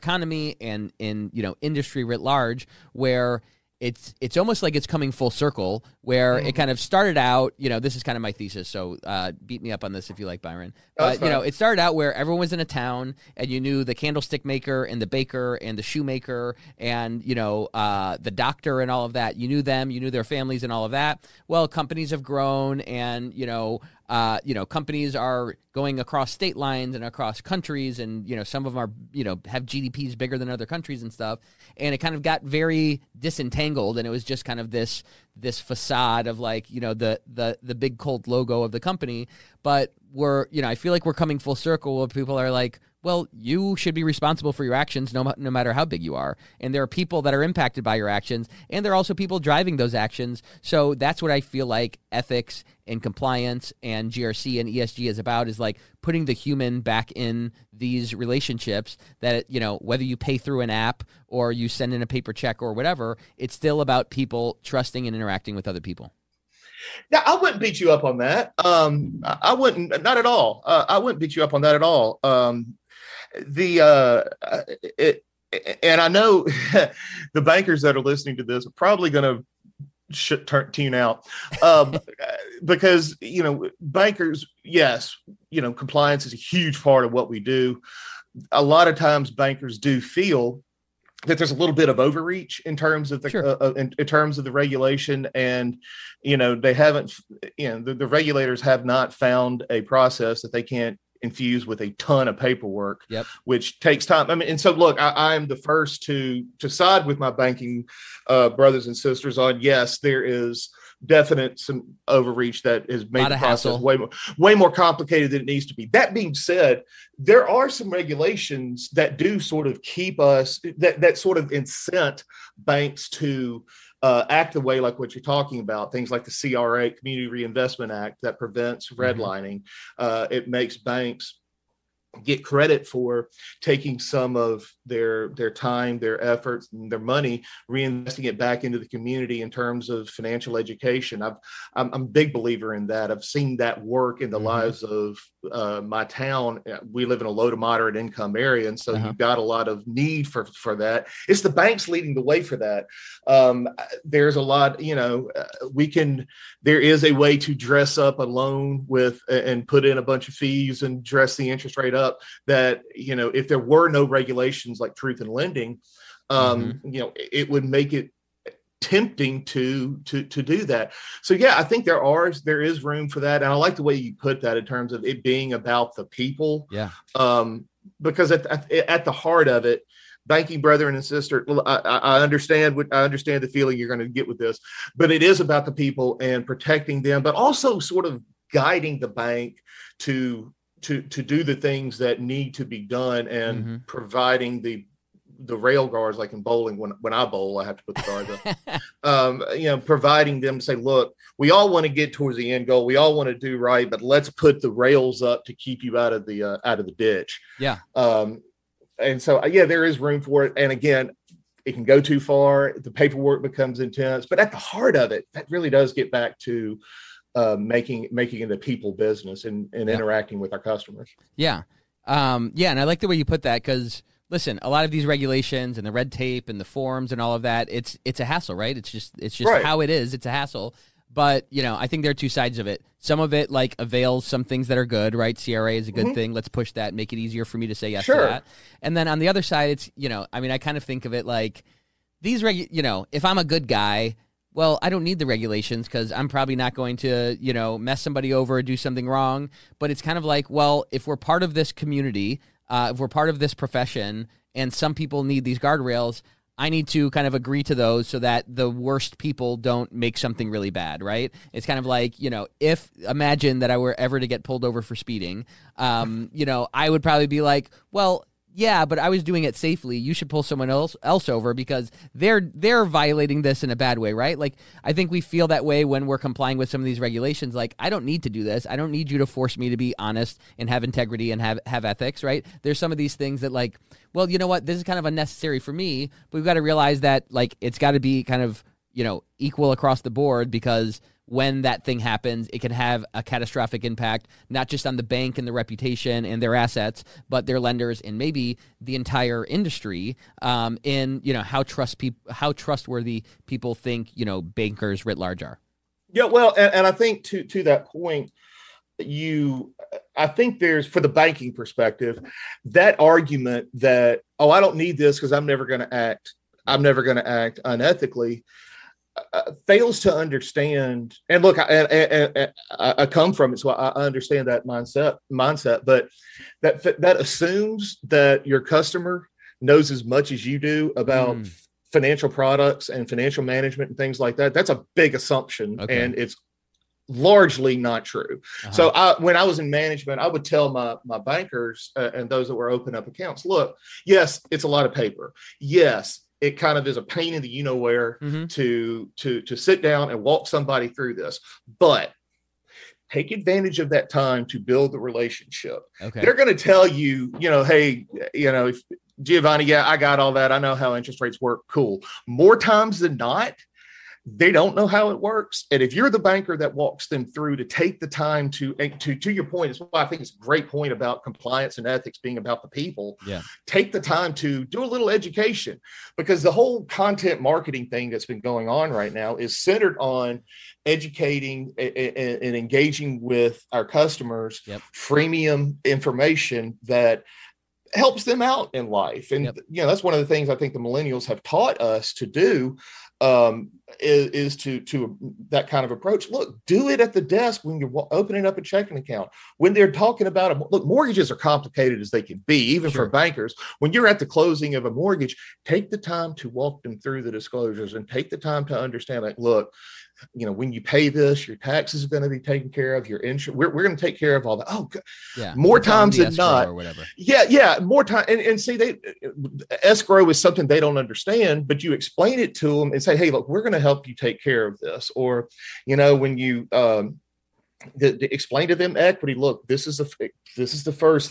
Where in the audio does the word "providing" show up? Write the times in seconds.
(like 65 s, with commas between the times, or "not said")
193 s, 199 s.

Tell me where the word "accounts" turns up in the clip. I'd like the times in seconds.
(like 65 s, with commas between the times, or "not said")
343 s, 398 s.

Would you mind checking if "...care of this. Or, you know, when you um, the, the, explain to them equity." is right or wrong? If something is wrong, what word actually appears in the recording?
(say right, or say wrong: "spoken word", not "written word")
right.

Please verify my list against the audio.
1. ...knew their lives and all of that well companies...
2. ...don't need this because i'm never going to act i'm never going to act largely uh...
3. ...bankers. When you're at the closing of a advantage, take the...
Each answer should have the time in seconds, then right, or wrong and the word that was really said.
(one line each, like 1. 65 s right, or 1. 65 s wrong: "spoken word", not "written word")
1. 19 s wrong: "families", not "lives"
2. 314 s wrong: "unethically", not "largely"
3. 403 s wrong: "mortgage", not "advantage".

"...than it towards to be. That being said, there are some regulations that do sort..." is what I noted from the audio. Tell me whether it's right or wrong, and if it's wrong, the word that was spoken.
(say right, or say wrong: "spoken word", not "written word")
wrong: "needs", not "towards".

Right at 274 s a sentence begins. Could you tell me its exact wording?
Like I think we feel that way when we're complying with some of these regulations.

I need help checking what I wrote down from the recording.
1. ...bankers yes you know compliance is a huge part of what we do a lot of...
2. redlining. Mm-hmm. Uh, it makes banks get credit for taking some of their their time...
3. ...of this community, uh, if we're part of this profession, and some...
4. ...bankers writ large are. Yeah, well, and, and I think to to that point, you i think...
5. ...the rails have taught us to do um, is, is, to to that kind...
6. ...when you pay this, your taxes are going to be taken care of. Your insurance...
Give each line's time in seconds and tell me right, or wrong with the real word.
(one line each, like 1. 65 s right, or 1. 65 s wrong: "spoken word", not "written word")
1. 83 s right
2. 129 s right
3. 251 s right
4. 304 s right
5. 390 s wrong: "millennials", not "rails"
6. 410 s right.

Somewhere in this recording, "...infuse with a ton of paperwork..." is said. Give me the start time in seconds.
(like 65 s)
101 s.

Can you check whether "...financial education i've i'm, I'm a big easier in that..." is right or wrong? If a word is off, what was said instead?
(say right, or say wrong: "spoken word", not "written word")
wrong: "believer", not "easier".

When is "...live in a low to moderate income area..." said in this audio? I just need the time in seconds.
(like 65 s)
147 s.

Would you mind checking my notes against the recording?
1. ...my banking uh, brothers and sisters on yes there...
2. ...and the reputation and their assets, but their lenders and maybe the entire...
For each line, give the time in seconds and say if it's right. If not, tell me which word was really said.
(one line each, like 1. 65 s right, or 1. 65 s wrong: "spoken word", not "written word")
1. 107 s right
2. 295 s right.